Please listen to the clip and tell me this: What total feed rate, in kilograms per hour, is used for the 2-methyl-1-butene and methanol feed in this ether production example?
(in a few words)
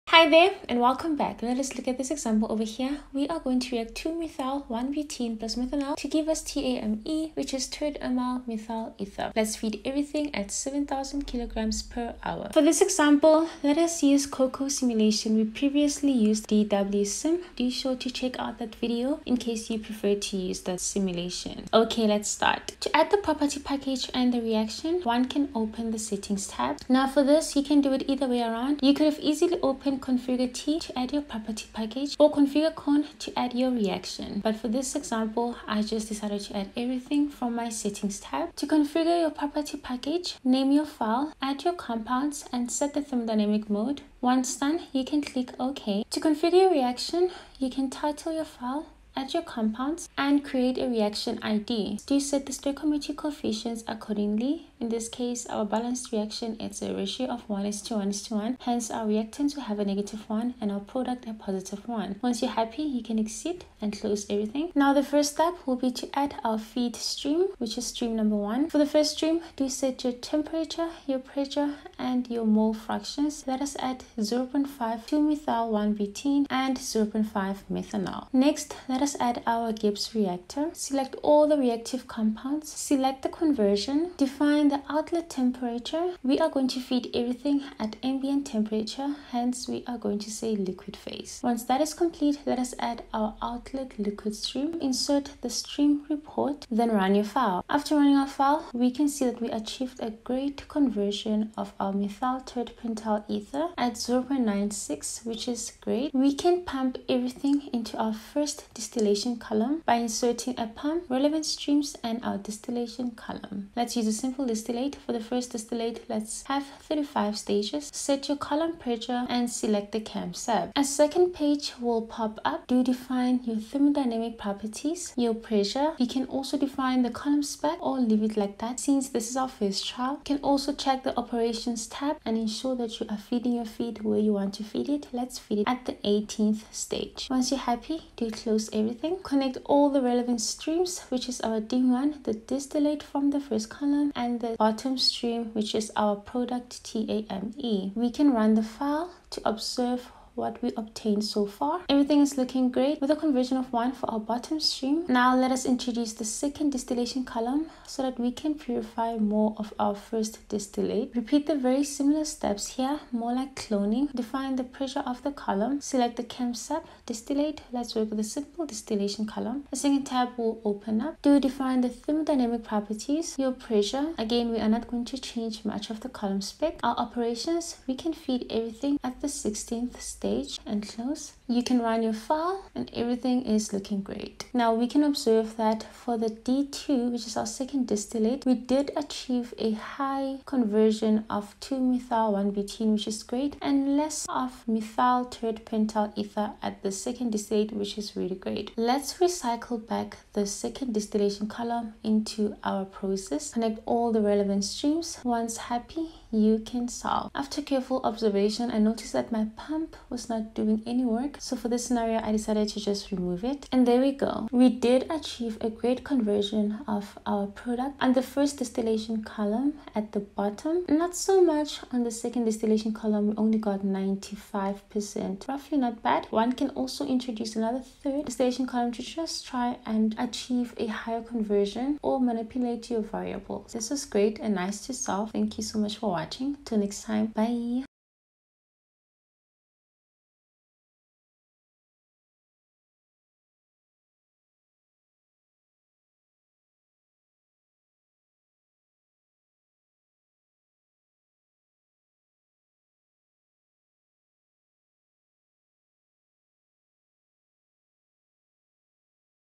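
7,000 kilograms per hour.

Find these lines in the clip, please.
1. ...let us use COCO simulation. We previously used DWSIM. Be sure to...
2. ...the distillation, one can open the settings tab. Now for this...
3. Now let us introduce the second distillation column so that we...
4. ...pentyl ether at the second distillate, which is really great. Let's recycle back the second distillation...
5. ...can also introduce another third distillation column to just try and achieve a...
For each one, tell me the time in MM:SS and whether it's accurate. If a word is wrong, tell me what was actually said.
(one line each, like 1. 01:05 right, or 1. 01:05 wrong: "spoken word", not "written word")
1. 00:13 right
2. 00:24 wrong: "reaction", not "distillation"
3. 02:35 right
4. 03:15 right
5. 03:46 right.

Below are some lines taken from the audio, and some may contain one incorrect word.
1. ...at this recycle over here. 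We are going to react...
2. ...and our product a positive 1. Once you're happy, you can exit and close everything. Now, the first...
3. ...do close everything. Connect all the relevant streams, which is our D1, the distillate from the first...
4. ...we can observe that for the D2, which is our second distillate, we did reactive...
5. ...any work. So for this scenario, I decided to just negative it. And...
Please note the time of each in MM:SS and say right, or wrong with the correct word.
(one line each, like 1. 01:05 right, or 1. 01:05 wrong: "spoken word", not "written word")
1. 00:01 wrong: "example", not "recycle"
2. 01:00 right
3. 02:18 right
4. 03:04 wrong: "achieve", not "reactive"
5. 03:30 wrong: "remove", not "negative".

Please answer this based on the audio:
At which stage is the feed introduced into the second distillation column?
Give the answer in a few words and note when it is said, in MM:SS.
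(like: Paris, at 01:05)
16th, at 02:59.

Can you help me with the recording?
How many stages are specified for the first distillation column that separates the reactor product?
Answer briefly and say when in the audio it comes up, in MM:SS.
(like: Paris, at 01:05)
35, at 01:56.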